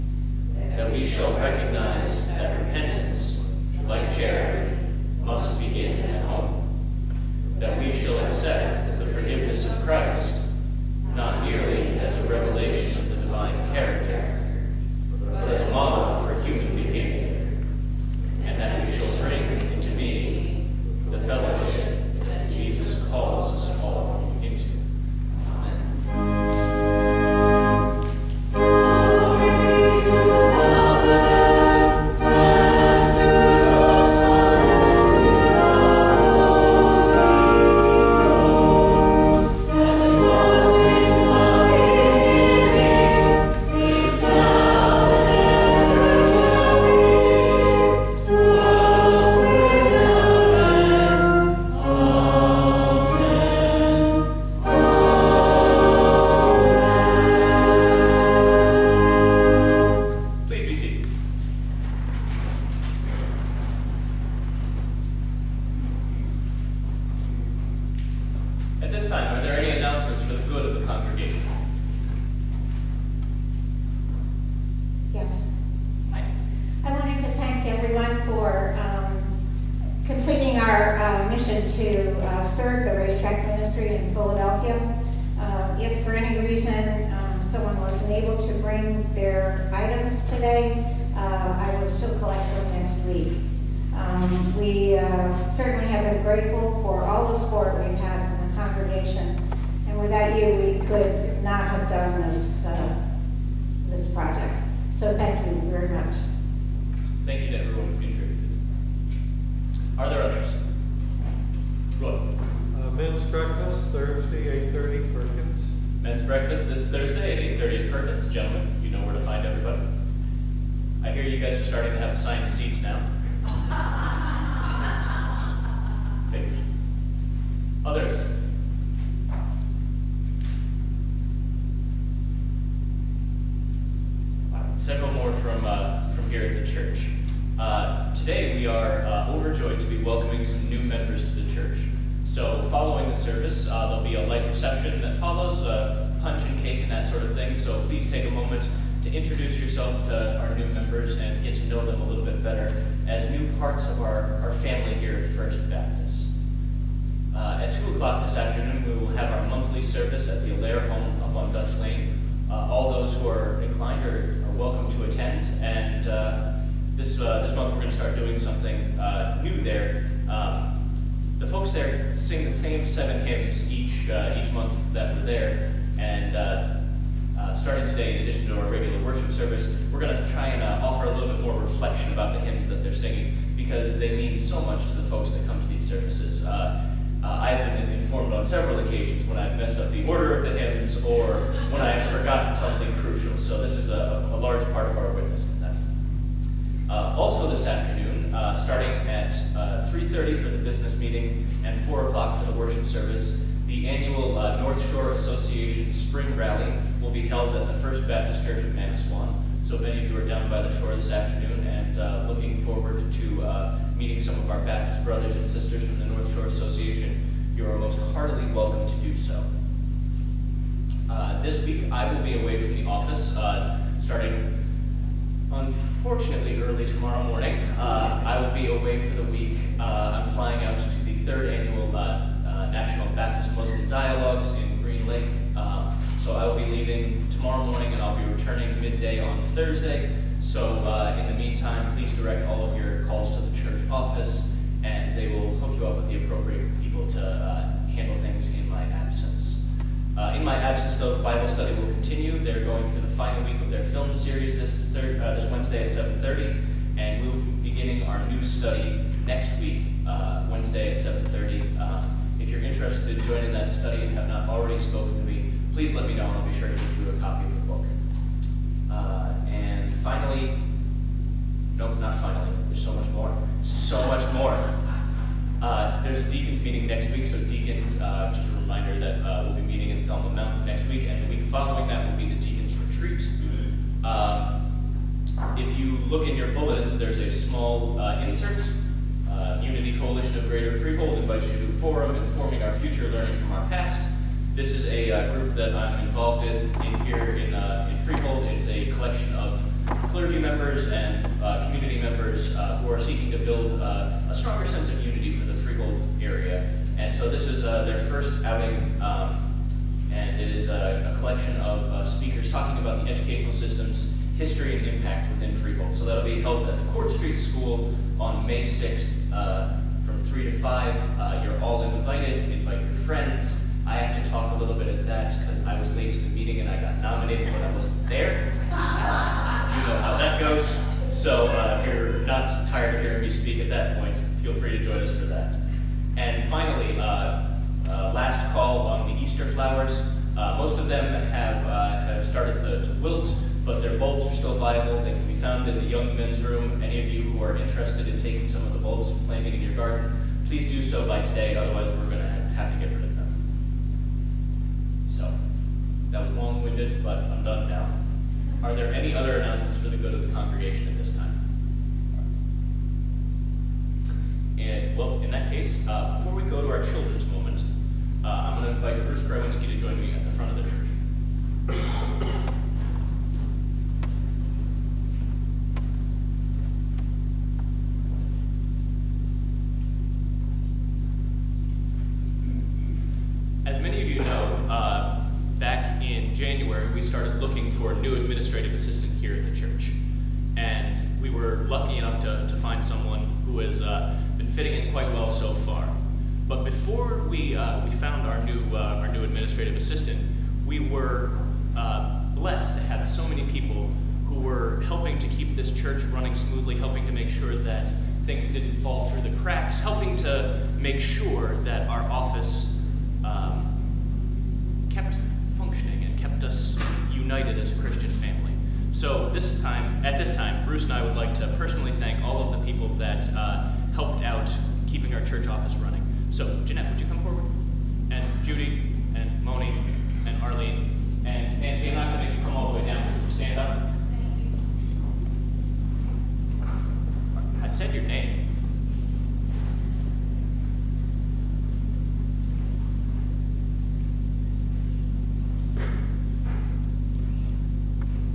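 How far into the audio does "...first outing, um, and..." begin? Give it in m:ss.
5:08.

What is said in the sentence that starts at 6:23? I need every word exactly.
As many of you know, uh, back in January, we started looking for a new administrative assistant here at the church.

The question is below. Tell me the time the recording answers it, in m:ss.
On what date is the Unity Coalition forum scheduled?
5:18.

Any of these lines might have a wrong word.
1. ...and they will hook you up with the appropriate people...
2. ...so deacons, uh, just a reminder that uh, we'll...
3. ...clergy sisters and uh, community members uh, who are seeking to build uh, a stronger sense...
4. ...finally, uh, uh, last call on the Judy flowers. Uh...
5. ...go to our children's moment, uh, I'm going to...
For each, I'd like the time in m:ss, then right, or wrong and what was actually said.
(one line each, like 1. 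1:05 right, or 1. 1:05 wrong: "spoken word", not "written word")
1. 4:04 right
2. 4:37 right
3. 5:00 wrong: "members", not "sisters"
4. 5:36 wrong: "Easter", not "Judy"
5. 6:06 right.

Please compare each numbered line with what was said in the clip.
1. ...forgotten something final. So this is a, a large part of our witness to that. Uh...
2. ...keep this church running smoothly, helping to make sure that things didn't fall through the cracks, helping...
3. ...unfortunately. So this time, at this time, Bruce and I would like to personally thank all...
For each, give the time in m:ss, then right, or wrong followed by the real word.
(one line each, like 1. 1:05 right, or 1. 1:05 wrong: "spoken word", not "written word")
1. 3:12 wrong: "crucial", not "final"
2. 6:45 right
3. 6:58 wrong: "family", not "unfortunately".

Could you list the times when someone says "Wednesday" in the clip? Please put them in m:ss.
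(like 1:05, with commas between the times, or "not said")
4:15, 4:20.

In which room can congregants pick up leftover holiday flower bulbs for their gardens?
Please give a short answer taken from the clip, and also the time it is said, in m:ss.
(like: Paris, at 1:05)
Young Men's Room, at 5:45.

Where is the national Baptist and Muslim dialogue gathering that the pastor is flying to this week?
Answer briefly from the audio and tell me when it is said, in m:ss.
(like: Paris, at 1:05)
Green Lake, at 3:54.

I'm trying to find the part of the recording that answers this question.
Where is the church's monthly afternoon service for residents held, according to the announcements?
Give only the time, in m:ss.
2:40.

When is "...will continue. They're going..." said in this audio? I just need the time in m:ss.
4:11.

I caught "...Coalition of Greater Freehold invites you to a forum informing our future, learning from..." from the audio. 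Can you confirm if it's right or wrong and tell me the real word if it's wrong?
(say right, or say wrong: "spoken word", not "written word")
right.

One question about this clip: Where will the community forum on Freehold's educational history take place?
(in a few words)
Court Street School.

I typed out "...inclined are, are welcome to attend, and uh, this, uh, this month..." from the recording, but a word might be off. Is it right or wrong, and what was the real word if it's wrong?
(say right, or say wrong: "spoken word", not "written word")
right.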